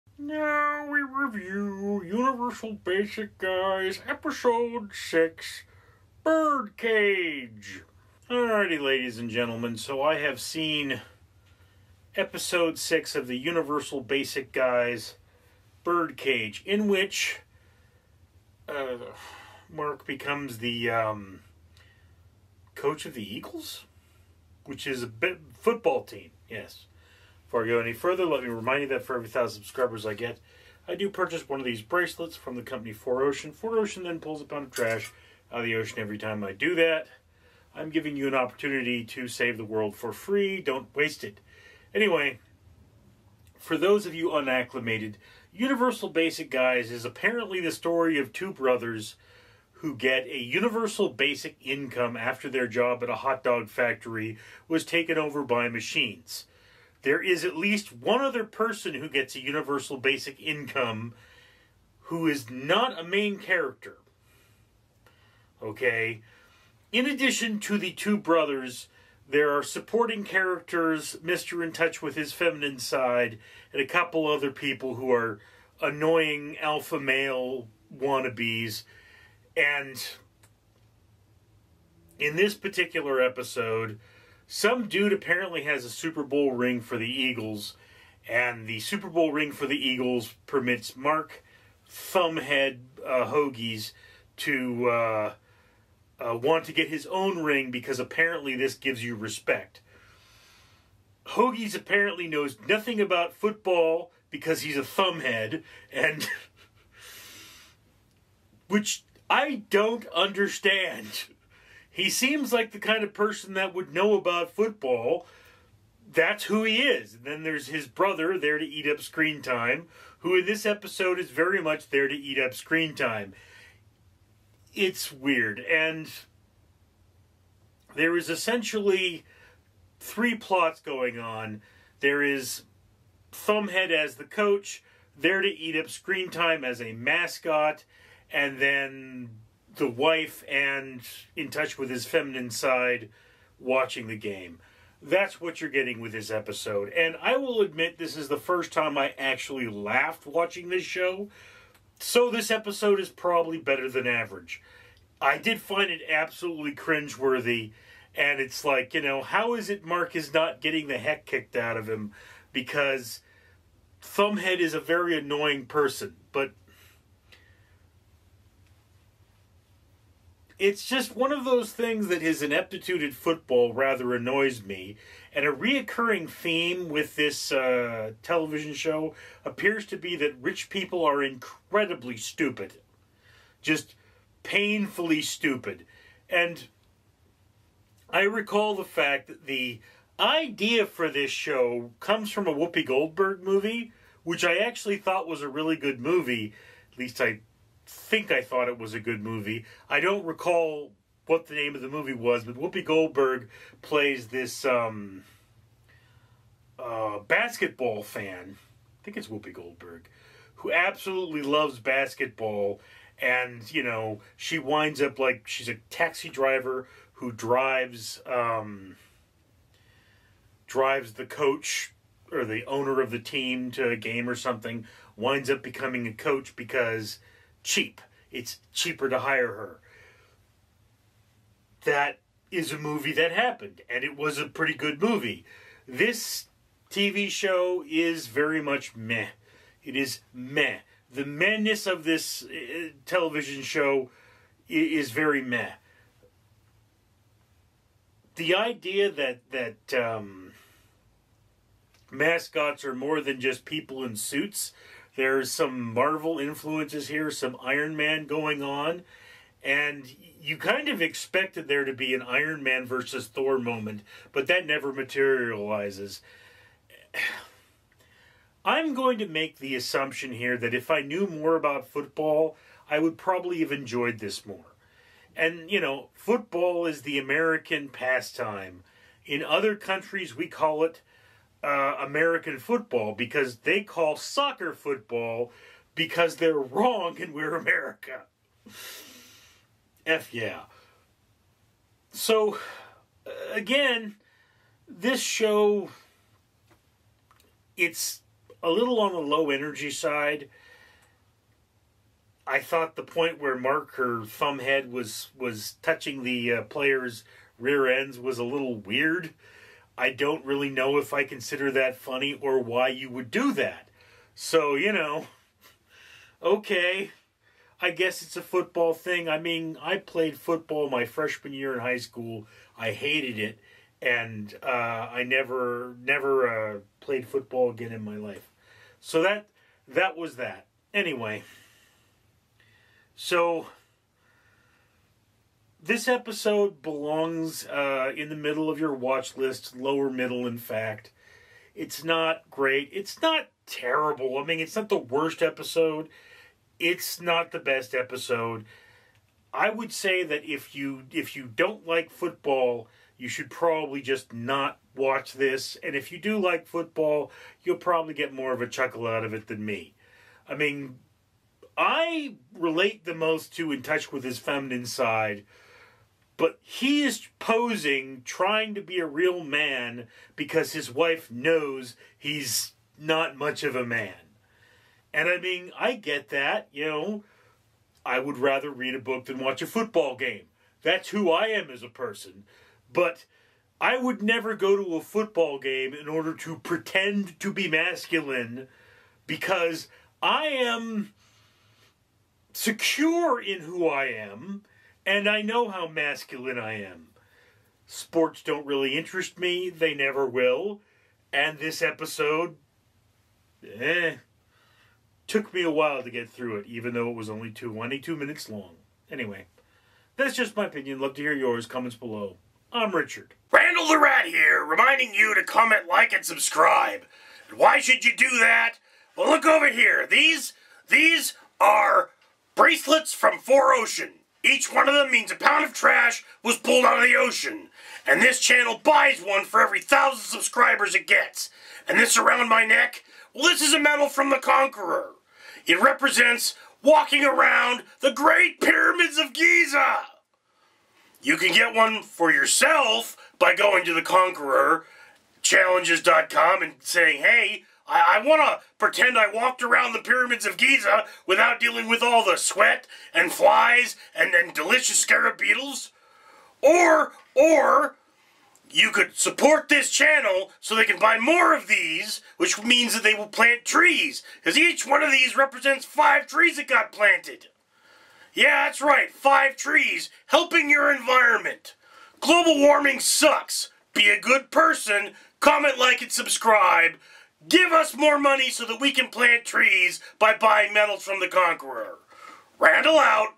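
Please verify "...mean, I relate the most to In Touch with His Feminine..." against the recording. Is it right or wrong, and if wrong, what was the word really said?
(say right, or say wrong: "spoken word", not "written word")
right.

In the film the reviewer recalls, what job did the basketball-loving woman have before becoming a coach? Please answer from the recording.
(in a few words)
taxi driver.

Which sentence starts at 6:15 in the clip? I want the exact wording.
And I mean, I get that, you know.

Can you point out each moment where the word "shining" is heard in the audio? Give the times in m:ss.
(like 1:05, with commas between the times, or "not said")
not said.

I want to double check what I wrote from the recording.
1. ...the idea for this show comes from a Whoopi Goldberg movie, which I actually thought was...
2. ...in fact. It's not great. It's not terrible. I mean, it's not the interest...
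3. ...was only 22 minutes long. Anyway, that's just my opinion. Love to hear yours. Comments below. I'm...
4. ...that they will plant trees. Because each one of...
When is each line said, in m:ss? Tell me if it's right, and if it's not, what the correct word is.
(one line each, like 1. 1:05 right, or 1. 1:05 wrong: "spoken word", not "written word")
1. 3:09 right
2. 5:40 wrong: "worst", not "interest"
3. 6:47 right
4. 7:42 right.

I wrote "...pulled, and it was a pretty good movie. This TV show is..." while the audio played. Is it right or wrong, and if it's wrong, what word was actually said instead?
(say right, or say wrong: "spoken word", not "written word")
wrong: "happened", not "pulled".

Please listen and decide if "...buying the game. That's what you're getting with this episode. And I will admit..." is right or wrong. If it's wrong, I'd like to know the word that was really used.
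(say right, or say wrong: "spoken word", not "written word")
wrong: "watching", not "buying".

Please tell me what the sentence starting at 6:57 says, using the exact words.
And why should you do that?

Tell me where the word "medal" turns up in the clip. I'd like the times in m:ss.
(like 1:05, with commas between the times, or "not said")
7:13, 8:00.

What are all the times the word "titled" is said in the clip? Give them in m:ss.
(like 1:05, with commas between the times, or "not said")
not said.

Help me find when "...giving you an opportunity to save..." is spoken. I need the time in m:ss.
0:37.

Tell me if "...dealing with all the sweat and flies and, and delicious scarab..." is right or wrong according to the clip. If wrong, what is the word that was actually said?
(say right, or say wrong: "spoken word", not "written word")
right.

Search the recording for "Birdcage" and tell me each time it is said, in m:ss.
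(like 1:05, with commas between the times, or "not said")
0:06, 0:15.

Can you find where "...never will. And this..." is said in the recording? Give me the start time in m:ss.
6:39.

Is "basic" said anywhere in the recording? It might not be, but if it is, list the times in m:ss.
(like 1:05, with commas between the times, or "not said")
0:02, 0:14, 0:46, 0:51, 0:59.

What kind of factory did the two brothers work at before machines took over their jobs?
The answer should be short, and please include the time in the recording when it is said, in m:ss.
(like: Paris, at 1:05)
hot dog factory, at 0:53.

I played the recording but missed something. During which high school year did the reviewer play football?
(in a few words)
freshman year.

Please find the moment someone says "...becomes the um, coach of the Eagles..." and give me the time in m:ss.
0:20.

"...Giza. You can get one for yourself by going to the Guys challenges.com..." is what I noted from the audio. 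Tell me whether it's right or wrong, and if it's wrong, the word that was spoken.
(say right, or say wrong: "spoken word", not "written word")
wrong: "Conqueror", not "Guys".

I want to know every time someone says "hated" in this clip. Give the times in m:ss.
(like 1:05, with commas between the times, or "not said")
5:22.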